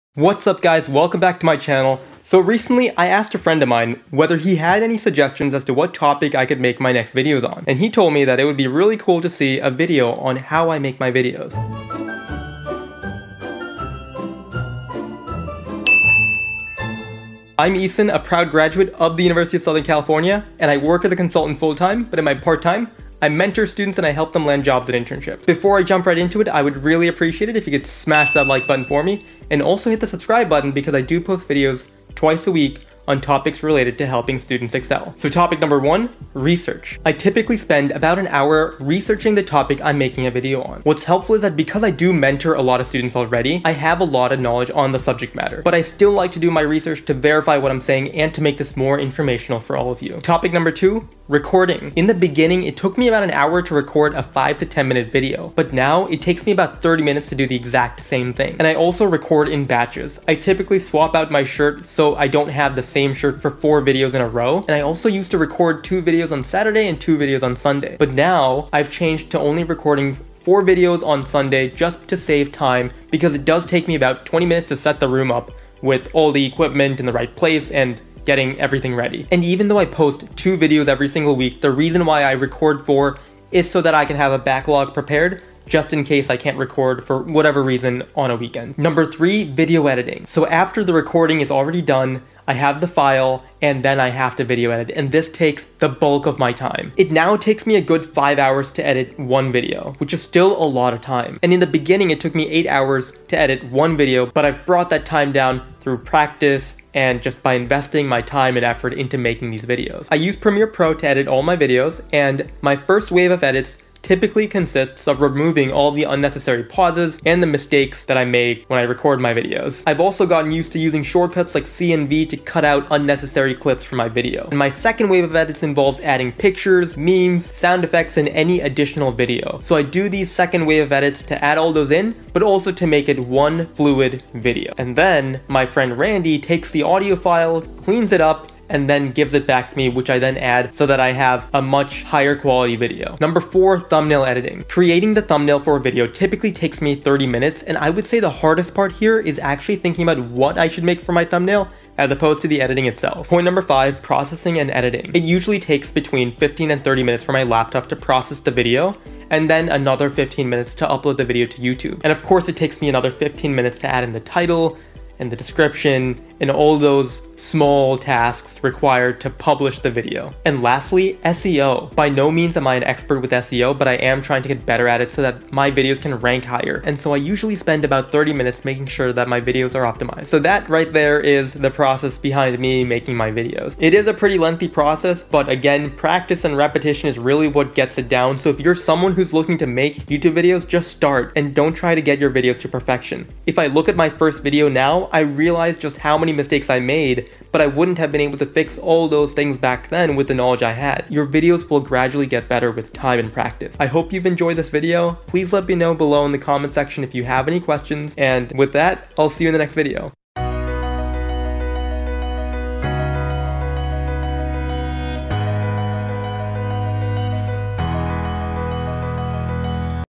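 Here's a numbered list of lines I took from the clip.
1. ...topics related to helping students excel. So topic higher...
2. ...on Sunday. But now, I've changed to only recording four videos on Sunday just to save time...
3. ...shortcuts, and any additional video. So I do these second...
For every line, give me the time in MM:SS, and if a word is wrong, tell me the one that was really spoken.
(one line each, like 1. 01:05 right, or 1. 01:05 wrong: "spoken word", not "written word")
1. 00:33 wrong: "number", not "higher"
2. 01:07 right
3. 02:07 wrong: "effects", not "shortcuts".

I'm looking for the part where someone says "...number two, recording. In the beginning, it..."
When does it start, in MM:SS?
00:50.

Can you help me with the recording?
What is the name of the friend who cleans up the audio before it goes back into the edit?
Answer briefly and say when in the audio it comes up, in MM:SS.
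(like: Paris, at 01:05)
Randy, at 02:15.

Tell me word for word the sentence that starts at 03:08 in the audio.
So if you're someone who's looking to make YouTube videos, just start and don't try to get your videos to perfection.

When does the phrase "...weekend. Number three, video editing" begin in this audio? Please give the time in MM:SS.
01:28.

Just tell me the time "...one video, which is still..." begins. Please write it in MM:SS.
01:39.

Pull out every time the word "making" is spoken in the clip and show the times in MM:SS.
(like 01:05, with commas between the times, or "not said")
00:39, 01:49, 02:58, 03:02.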